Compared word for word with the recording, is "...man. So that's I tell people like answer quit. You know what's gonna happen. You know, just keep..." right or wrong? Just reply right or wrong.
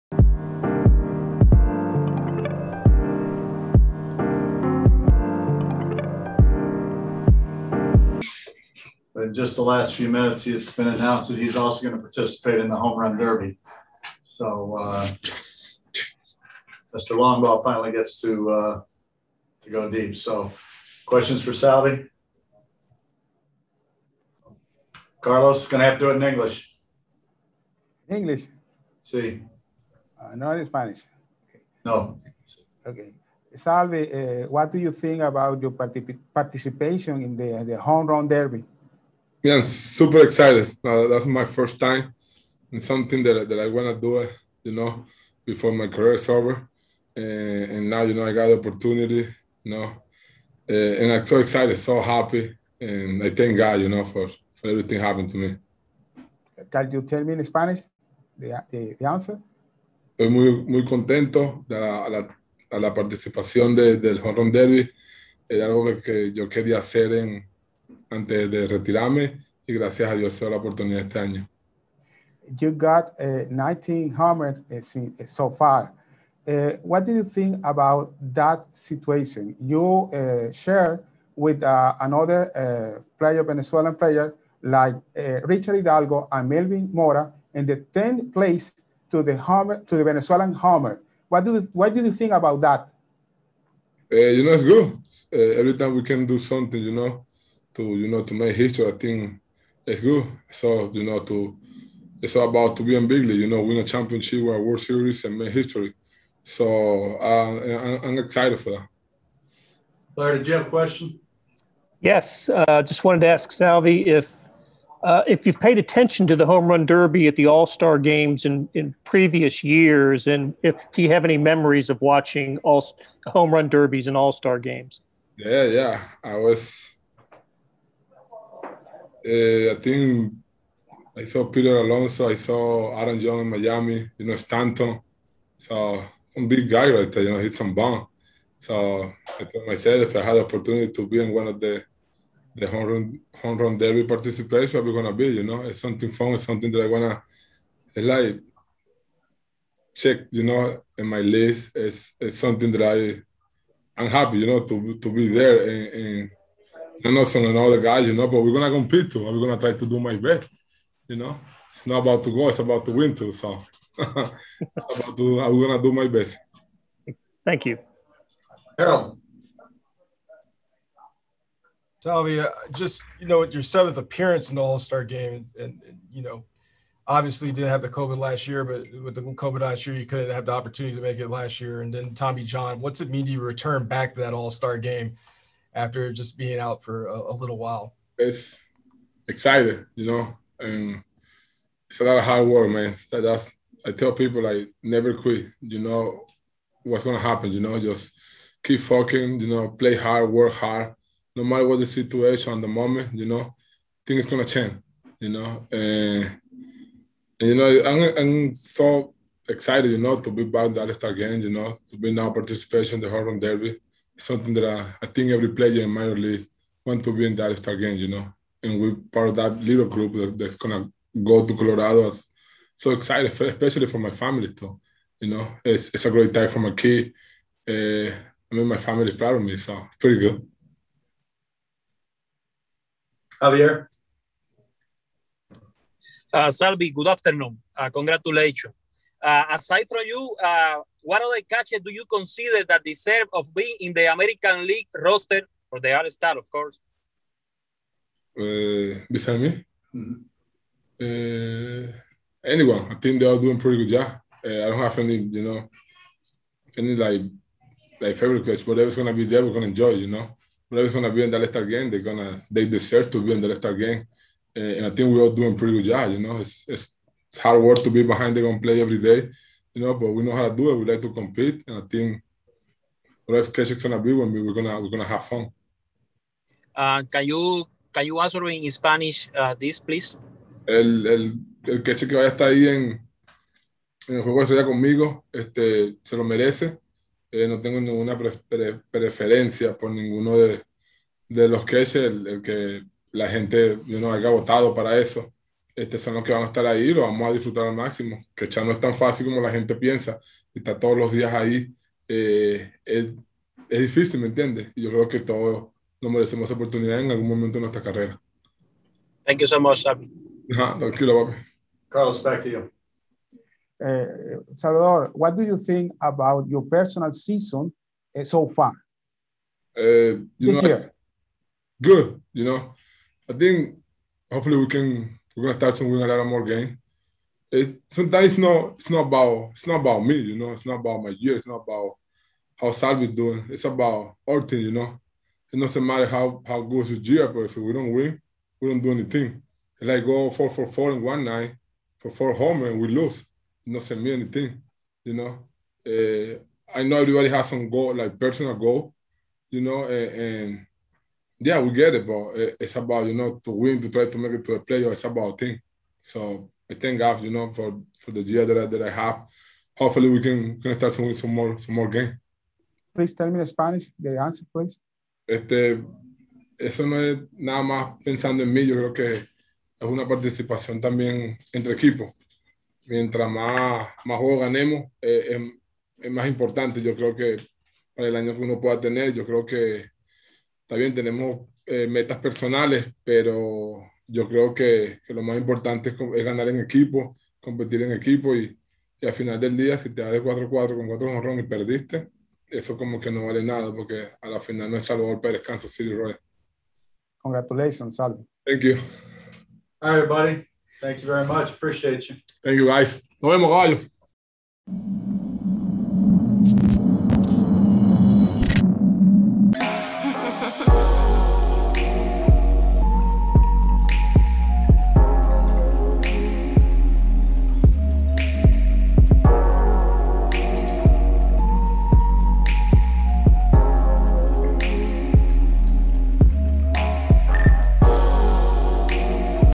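wrong.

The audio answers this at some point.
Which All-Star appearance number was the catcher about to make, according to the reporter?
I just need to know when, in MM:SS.
02:53.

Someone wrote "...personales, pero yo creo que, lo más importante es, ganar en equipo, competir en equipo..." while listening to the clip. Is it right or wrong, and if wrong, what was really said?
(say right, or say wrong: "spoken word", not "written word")
right.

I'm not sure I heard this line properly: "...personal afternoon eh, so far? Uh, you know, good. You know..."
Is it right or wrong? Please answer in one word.
wrong.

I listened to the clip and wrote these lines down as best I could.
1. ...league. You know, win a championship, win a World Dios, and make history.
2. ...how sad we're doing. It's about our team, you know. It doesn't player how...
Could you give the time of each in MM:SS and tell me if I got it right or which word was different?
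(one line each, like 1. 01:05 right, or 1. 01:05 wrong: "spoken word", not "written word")
1. 01:43 wrong: "Series", not "Dios"
2. 05:32 wrong: "matter", not "player".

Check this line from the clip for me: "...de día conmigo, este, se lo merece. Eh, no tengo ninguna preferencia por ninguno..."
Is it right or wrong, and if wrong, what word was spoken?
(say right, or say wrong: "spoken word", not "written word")
right.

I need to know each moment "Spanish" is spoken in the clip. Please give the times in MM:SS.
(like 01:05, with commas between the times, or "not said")
00:30, 00:57, 04:38, 06:03.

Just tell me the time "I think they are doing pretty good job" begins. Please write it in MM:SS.
04:12.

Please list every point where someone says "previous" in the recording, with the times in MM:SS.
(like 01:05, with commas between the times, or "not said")
01:59.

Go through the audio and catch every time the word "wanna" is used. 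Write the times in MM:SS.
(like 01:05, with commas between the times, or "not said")
02:26.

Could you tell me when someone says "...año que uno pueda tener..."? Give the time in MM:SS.
06:18.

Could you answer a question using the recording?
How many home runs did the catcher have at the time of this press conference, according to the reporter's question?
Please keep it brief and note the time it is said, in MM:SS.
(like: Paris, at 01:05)
19, at 01:13.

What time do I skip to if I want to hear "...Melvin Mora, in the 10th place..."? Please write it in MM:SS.
01:26.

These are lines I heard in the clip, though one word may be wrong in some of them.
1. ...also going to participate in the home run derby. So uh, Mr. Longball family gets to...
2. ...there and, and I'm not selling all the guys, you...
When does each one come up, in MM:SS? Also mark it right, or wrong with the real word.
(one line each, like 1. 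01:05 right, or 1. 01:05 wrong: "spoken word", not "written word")
1. 00:11 wrong: "finally", not "family"
2. 02:35 right.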